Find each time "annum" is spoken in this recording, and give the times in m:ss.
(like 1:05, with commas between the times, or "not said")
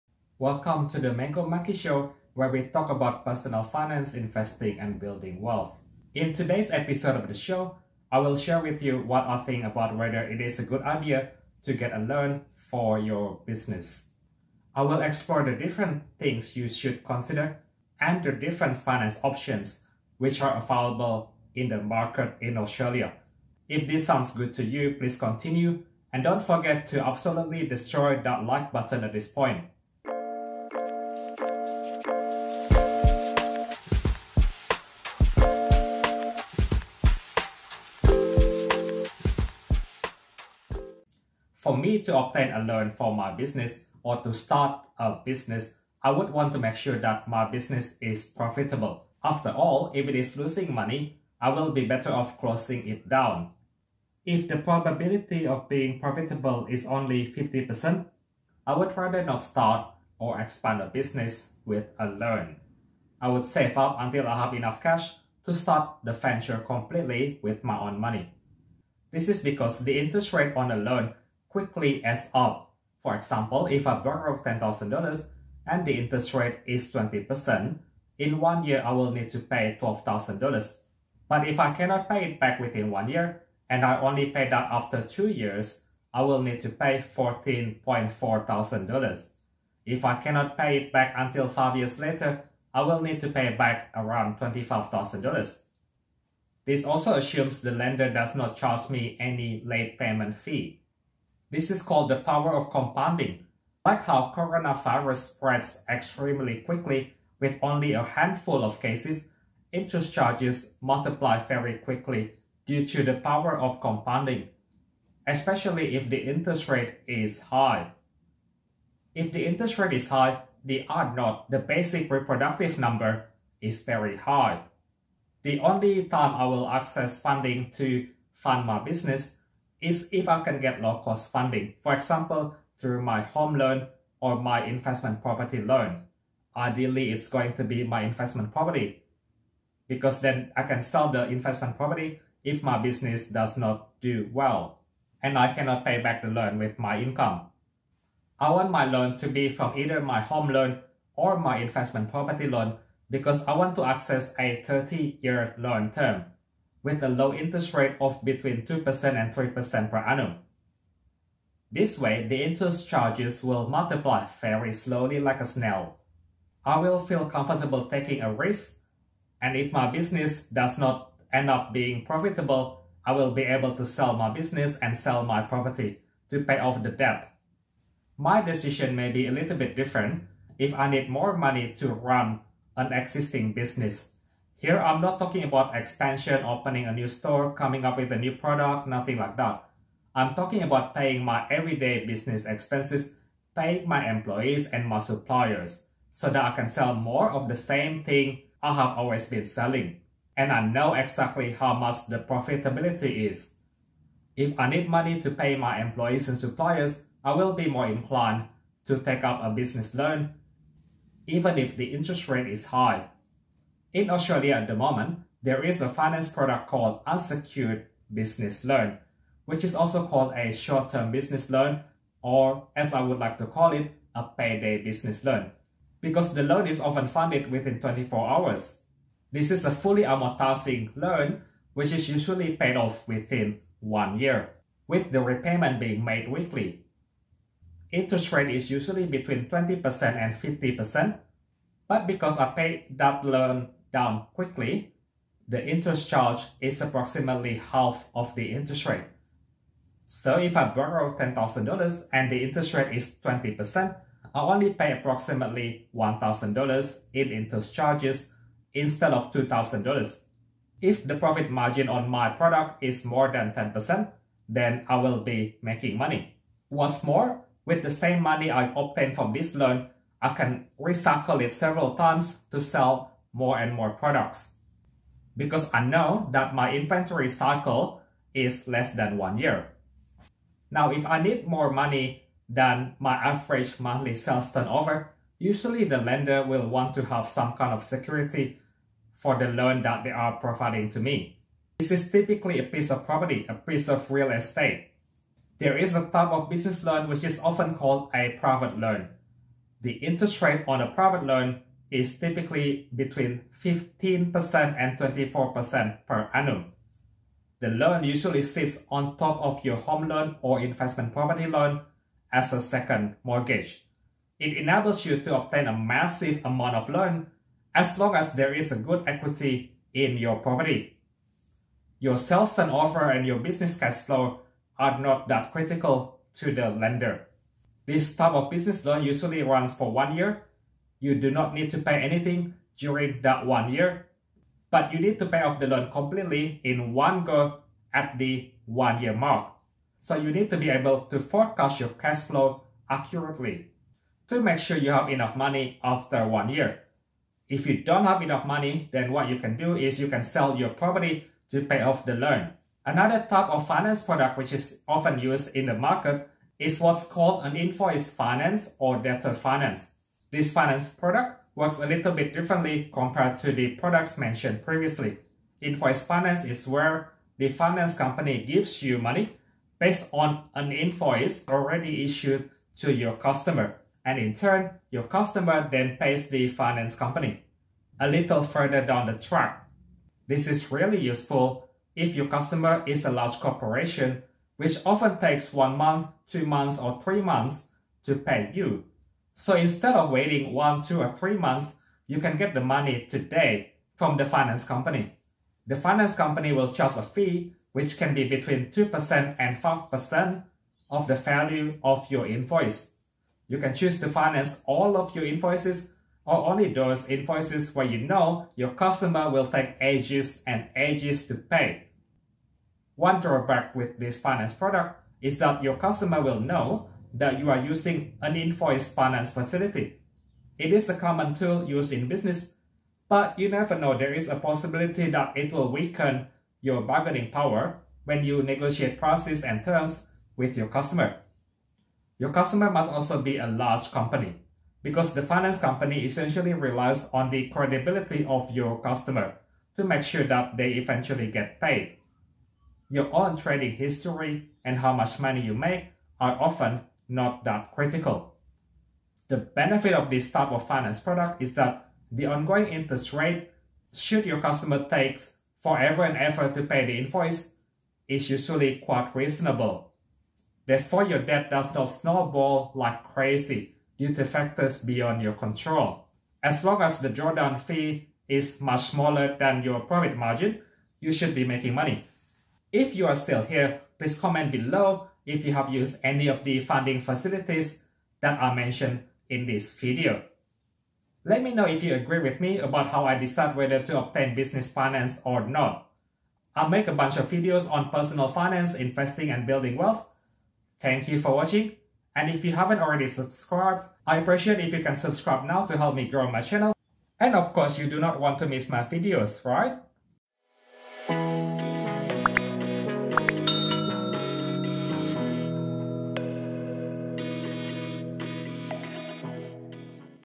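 2:39, 5:06.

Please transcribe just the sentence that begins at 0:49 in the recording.
After all, if it is losing money, I will be better off closing it down.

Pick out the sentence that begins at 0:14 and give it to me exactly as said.
I will explore the different things you should consider and the different finance options which are available in the market in Australia.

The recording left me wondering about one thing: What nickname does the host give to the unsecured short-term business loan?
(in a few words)
payday business loan.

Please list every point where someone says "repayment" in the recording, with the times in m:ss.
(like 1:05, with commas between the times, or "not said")
3:55.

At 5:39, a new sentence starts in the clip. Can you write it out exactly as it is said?
So you need to be able to forecast your cash flow accurately to make sure you have enough money after one year.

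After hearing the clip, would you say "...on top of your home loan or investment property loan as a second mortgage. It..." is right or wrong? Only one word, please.
right.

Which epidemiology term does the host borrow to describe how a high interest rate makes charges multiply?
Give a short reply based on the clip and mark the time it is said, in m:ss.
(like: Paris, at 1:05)
basic reproductive number, at 2:01.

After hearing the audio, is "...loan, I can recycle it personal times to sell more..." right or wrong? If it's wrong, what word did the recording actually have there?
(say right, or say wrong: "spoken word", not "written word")
wrong: "several", not "personal".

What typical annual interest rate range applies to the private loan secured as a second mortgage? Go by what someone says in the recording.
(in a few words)
15% to 24%.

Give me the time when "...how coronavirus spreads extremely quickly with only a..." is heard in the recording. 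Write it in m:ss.
1:44.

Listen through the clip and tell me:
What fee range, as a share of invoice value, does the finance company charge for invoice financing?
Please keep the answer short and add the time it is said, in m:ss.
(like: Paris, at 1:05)
2% to 5%, at 6:38.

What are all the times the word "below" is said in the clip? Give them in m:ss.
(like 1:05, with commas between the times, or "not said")
7:54.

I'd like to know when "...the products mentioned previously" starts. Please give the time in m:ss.
6:03.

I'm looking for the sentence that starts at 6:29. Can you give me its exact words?
So instead of waiting one, two, or three months, you can get the money today from the finance company.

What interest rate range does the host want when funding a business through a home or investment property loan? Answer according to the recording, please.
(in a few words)
2% to 3%.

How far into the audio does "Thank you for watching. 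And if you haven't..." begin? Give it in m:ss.
8:10.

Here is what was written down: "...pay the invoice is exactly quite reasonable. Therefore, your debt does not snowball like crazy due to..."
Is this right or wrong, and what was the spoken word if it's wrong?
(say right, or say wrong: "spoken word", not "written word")
wrong: "usually", not "exactly".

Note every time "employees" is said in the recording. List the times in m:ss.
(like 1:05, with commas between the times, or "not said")
3:14, 3:25.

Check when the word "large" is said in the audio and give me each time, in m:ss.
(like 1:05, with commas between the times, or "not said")
6:23, 7:13.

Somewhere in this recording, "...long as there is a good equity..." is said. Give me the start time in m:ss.
5:17.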